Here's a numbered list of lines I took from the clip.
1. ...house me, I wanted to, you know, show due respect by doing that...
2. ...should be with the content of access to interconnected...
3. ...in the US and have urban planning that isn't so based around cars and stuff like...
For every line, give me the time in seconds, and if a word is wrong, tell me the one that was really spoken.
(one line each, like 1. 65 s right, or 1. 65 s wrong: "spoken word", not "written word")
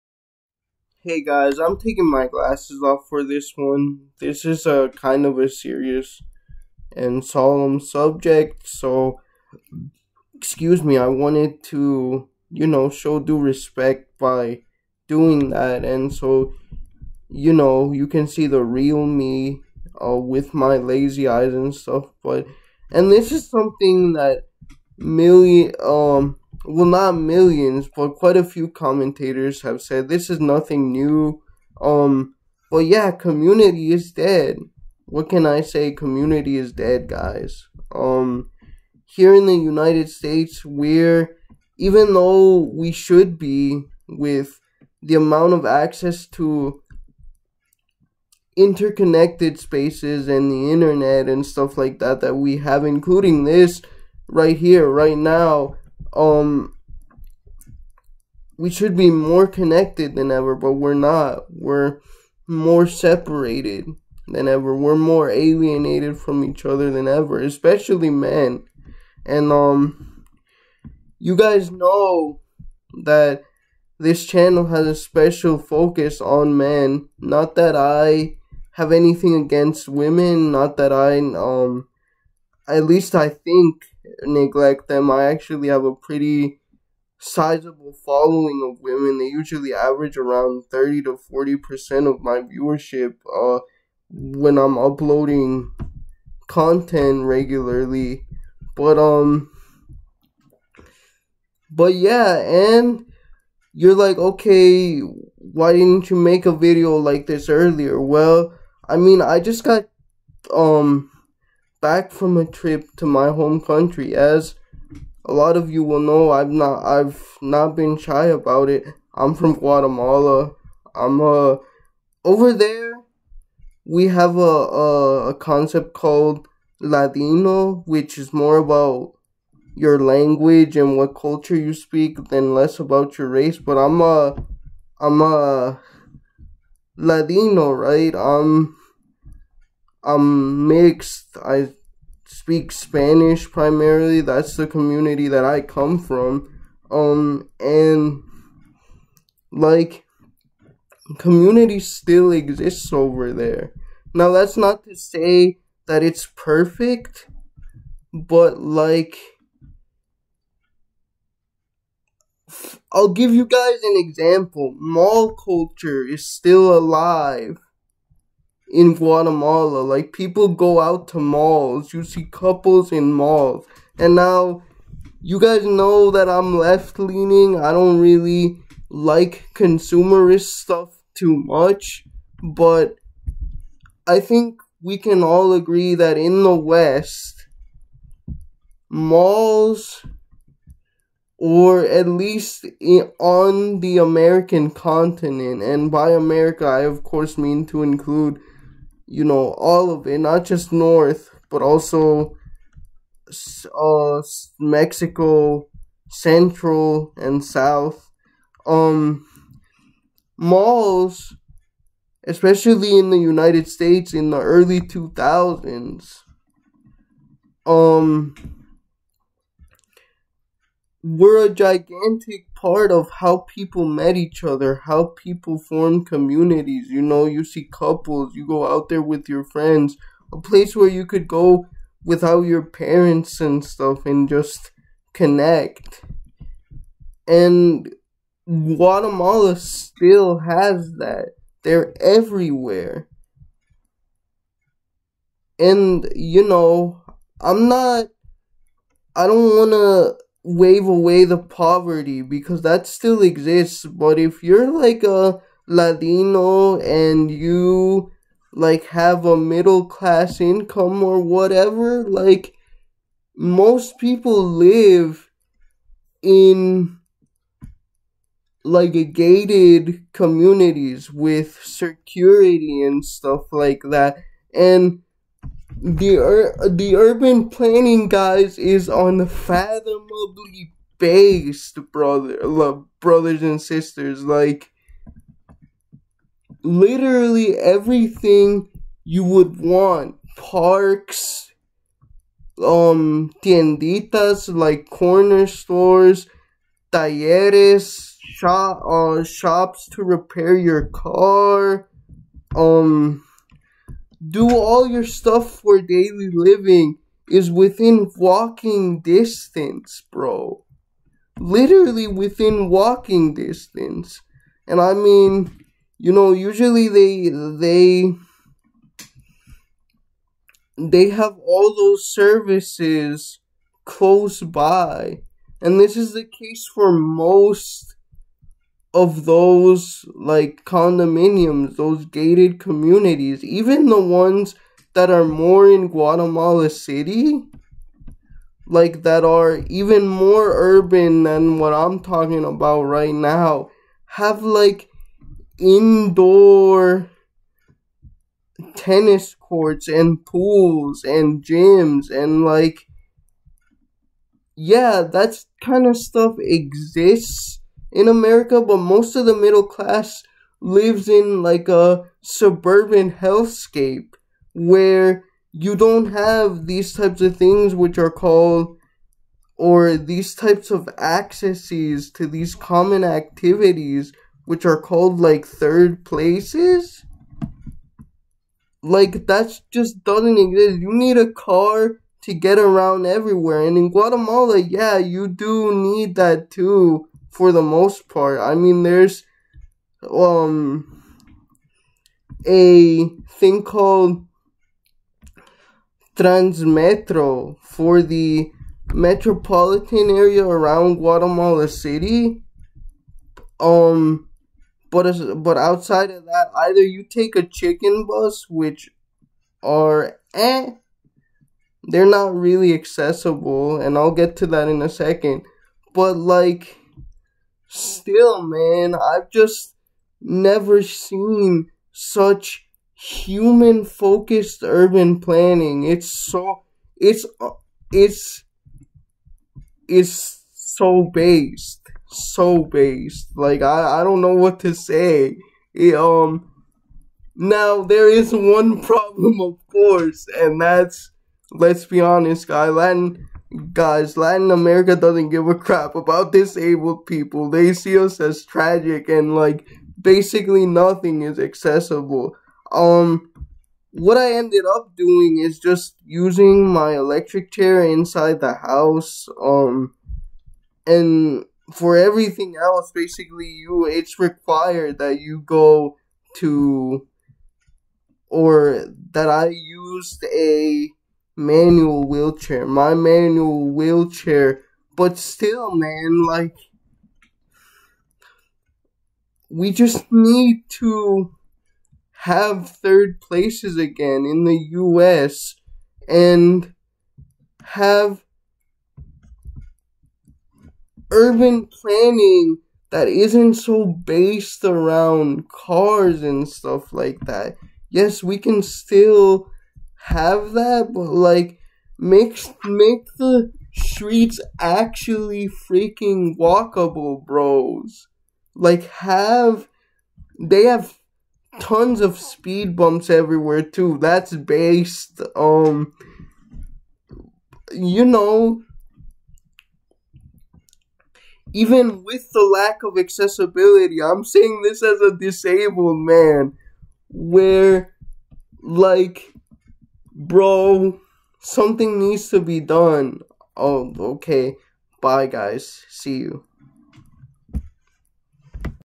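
1. 10 s wrong: "excuse", not "house"
2. 42 s wrong: "amount", not "content"
3. 484 s right.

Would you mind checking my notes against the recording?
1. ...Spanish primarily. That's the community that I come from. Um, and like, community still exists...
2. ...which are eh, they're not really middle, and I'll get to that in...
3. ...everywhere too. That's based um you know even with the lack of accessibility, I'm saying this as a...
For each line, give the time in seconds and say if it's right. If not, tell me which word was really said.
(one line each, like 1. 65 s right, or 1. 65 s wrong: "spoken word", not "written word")
1. 142 s right
2. 408 s wrong: "accessible", not "middle"
3. 513 s right.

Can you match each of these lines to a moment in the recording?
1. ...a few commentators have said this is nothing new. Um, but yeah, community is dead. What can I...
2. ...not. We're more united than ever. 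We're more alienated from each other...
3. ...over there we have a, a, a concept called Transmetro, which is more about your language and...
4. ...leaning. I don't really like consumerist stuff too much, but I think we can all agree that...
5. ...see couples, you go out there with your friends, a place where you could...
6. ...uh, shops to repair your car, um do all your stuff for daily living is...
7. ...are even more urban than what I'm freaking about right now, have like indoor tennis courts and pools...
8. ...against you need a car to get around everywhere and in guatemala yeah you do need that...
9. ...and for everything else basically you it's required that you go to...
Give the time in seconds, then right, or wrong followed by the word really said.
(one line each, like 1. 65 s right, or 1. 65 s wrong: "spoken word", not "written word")
1. 28 s right
2. 60 s wrong: "separated", not "united"
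3. 122 s wrong: "Latino", not "Transmetro"
4. 176 s right
5. 227 s right
6. 298 s right
7. 339 s wrong: "talking", not "freaking"
8. 380 s wrong: "exist", not "against"
9. 460 s right.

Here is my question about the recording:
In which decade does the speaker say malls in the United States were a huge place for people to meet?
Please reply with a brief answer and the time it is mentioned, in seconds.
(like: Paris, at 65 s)
early 2000s, at 214 s.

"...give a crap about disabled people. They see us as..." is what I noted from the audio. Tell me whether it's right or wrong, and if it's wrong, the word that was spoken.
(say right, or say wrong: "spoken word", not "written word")
right.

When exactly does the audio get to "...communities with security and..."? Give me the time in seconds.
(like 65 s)
270 s.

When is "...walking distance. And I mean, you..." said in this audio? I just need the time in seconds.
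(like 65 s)
312 s.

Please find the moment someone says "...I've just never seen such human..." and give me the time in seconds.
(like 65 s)
418 s.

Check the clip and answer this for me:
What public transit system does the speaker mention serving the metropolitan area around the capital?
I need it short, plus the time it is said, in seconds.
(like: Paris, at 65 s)
Transmetro, at 396 s.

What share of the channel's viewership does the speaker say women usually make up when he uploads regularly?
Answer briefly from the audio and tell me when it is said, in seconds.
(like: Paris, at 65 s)
30 to 40%, at 90 s.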